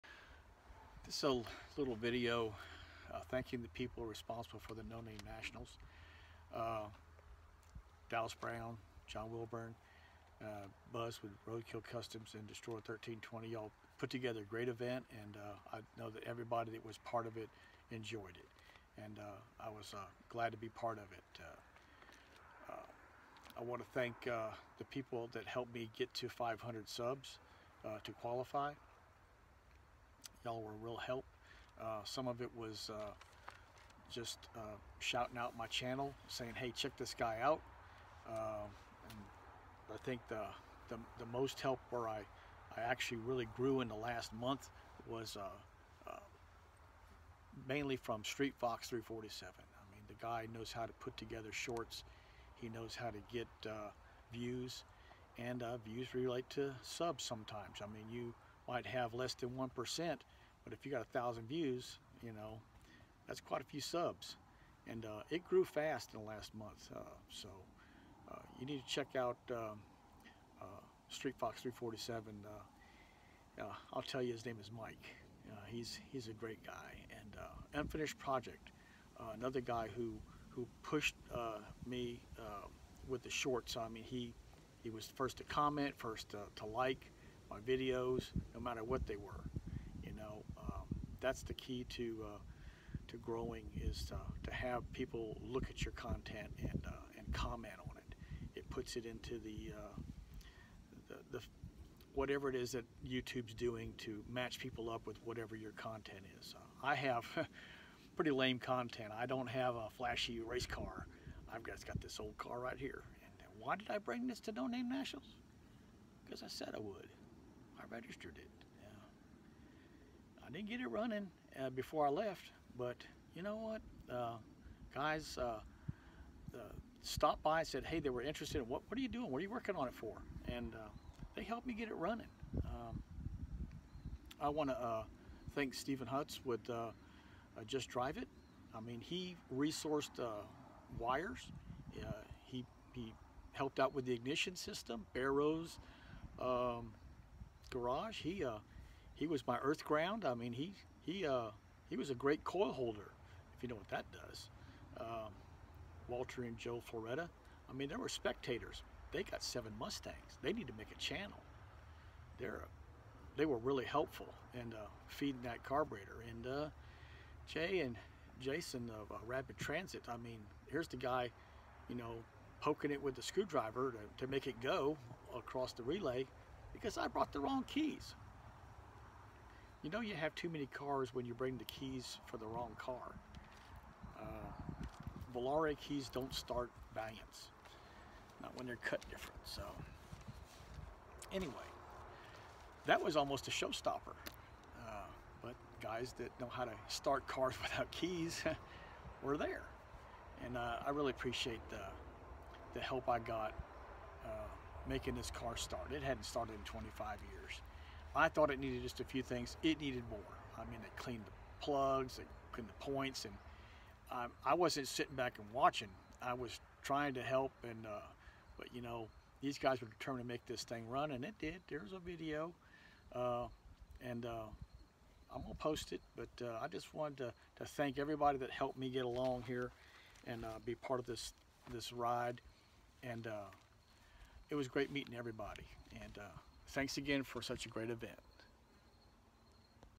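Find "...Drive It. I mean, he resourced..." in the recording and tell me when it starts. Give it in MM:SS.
02:17.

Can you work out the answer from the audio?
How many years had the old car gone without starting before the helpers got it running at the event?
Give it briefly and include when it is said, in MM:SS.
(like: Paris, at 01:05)
25, at 03:26.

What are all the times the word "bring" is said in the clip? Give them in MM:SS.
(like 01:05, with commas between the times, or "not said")
01:53, 03:01.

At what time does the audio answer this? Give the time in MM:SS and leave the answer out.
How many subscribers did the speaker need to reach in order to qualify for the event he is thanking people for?
00:26.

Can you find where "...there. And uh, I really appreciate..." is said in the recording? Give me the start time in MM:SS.
03:19.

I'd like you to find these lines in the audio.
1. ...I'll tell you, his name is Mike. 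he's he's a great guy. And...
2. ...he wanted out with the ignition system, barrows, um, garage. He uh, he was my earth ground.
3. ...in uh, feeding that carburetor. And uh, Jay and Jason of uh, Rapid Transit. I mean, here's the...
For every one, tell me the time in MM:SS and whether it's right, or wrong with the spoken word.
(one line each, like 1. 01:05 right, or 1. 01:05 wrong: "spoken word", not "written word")
1. 01:13 right
2. 02:22 wrong: "helped", not "wanted"
3. 02:44 right.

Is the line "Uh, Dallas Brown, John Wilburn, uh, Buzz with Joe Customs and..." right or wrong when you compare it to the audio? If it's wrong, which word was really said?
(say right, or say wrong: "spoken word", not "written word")
wrong: "Roadkill", not "Joe".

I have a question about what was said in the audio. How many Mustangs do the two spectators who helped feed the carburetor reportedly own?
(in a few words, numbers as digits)
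7.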